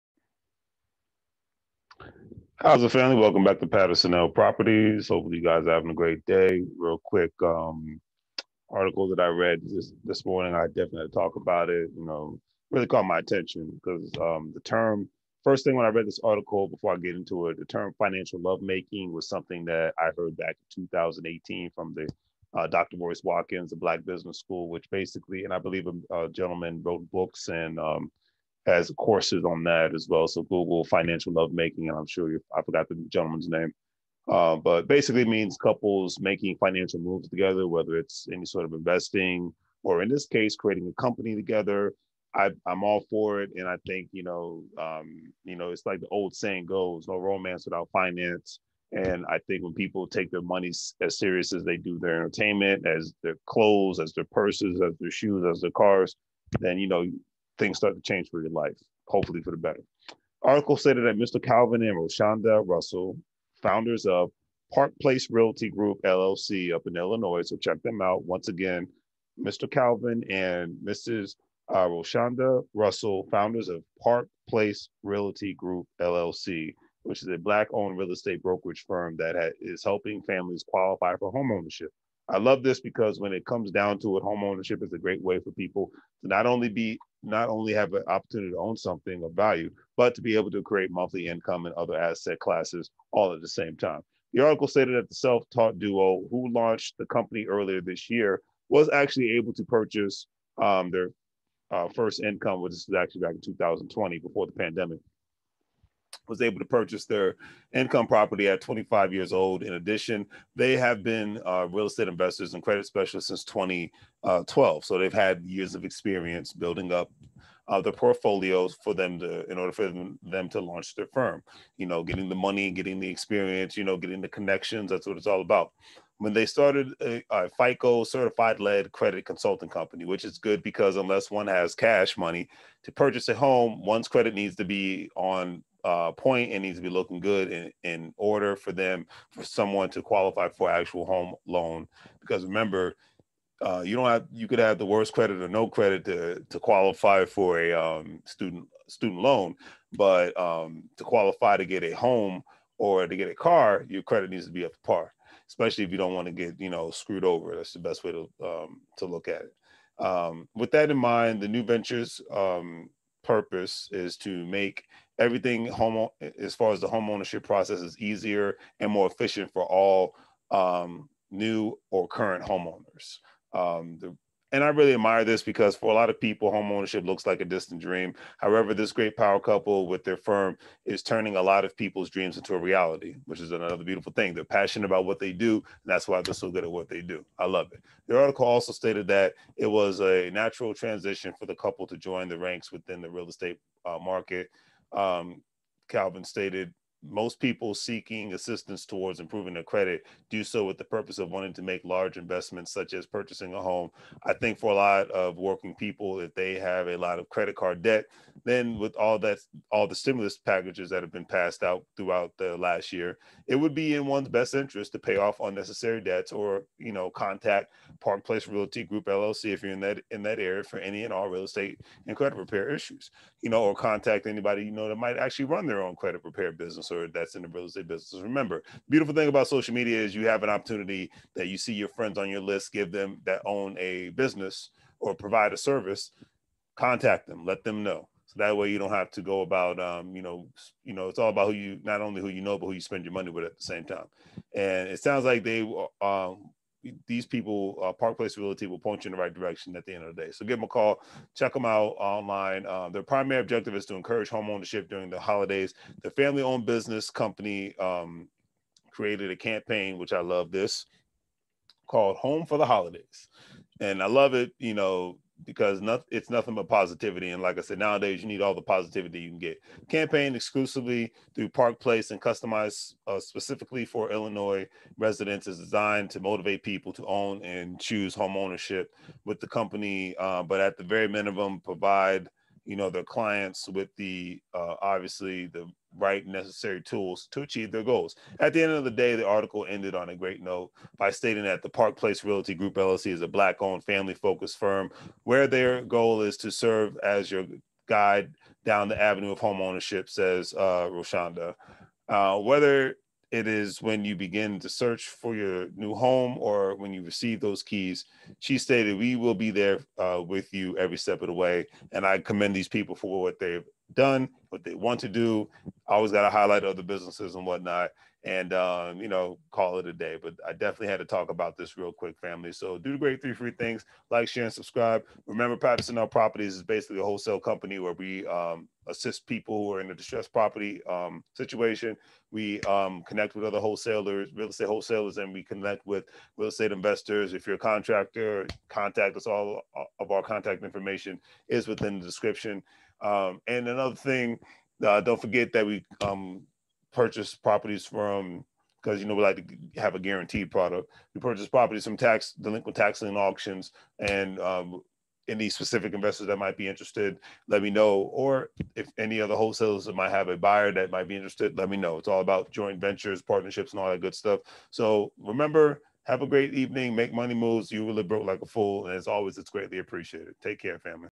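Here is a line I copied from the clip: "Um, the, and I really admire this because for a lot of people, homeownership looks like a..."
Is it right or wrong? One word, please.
right.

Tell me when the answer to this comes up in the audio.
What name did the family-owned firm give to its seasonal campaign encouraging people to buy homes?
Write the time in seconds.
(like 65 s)
262 s.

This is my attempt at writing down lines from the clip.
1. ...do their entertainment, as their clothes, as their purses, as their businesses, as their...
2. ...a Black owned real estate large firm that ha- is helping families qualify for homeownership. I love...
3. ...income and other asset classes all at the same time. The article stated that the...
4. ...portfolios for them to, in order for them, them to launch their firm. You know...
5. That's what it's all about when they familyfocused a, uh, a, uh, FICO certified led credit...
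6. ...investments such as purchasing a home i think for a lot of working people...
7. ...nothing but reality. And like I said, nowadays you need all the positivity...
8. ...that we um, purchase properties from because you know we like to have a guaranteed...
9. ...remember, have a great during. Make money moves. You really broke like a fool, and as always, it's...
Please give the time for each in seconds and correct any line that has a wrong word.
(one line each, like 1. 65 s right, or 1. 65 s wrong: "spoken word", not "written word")
1. 51 s wrong: "shoes", not "businesses"
2. 77 s wrong: "brokerage", not "large"
3. 91 s right
4. 117 s right
5. 124 s wrong: "started", not "familyfocused"
6. 202 s right
7. 266 s wrong: "positivity", not "reality"
8. 345 s right
9. 365 s wrong: "evening", not "during".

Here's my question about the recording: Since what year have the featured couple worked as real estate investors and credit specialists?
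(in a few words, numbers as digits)
2012.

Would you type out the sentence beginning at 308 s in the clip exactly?
She stated, We will be there uh, with you every step of the way.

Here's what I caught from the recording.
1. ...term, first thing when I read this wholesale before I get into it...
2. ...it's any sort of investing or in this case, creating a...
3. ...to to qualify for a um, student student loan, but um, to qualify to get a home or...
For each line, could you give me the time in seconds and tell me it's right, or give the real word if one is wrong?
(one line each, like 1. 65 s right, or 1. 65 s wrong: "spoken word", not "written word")
1. 14 s wrong: "article", not "wholesale"
2. 37 s right
3. 146 s right.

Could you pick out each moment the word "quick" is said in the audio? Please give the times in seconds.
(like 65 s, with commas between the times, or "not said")
7 s, 321 s.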